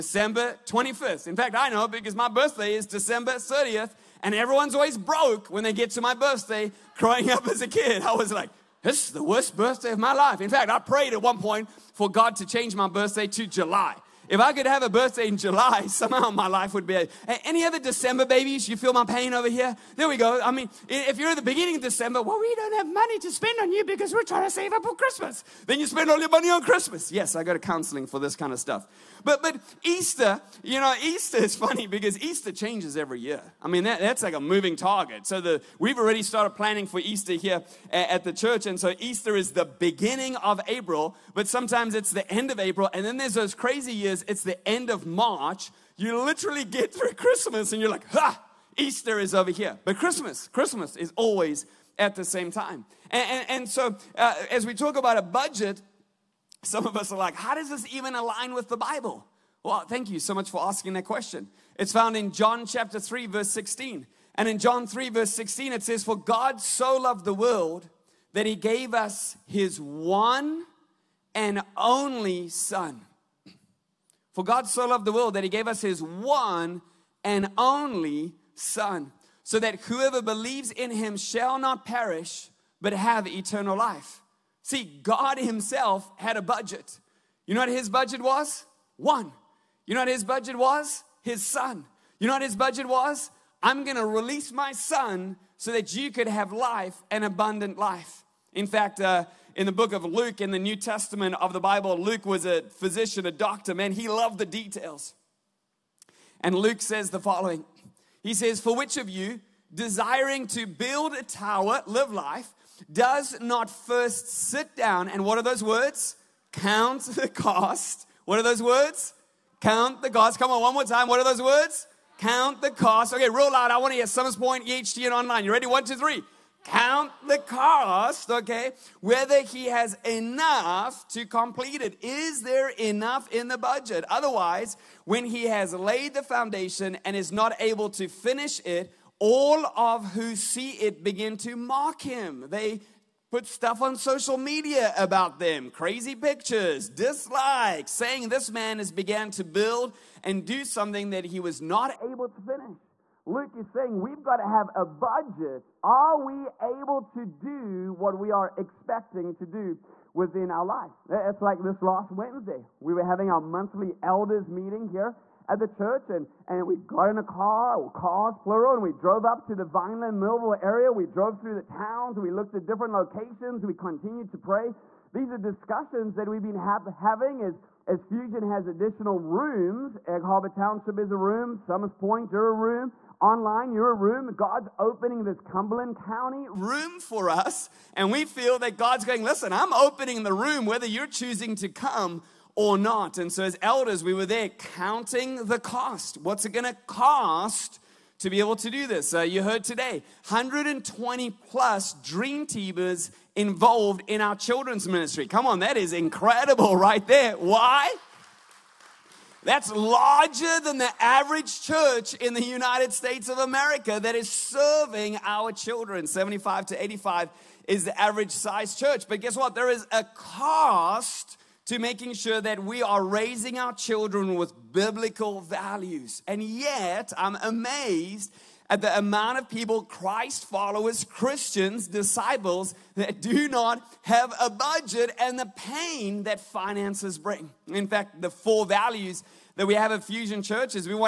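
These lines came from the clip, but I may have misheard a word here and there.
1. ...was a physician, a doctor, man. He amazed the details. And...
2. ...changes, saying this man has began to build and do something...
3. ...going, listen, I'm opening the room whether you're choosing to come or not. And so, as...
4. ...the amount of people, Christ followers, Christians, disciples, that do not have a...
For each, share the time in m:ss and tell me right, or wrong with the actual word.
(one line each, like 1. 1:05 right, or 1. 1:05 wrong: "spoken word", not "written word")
1. 1:42 wrong: "loved", not "amazed"
2. 2:26 wrong: "dislikes", not "changes"
3. 3:09 right
4. 3:48 right.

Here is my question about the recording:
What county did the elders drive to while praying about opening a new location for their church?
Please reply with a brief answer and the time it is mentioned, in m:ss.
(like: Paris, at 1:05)
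Cumberland County, at 3:05.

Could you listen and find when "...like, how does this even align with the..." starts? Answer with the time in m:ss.
0:57.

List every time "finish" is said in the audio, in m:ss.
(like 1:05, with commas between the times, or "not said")
2:18, 2:32.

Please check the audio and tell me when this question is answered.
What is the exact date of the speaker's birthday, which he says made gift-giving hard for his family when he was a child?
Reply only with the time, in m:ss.
0:02.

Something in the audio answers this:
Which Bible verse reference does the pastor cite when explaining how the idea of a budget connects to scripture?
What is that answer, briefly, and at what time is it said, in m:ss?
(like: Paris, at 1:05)
John 3:16, at 1:02.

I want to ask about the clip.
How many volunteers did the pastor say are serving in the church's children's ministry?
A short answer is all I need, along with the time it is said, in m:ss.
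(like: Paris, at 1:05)
120 plus, at 3:20.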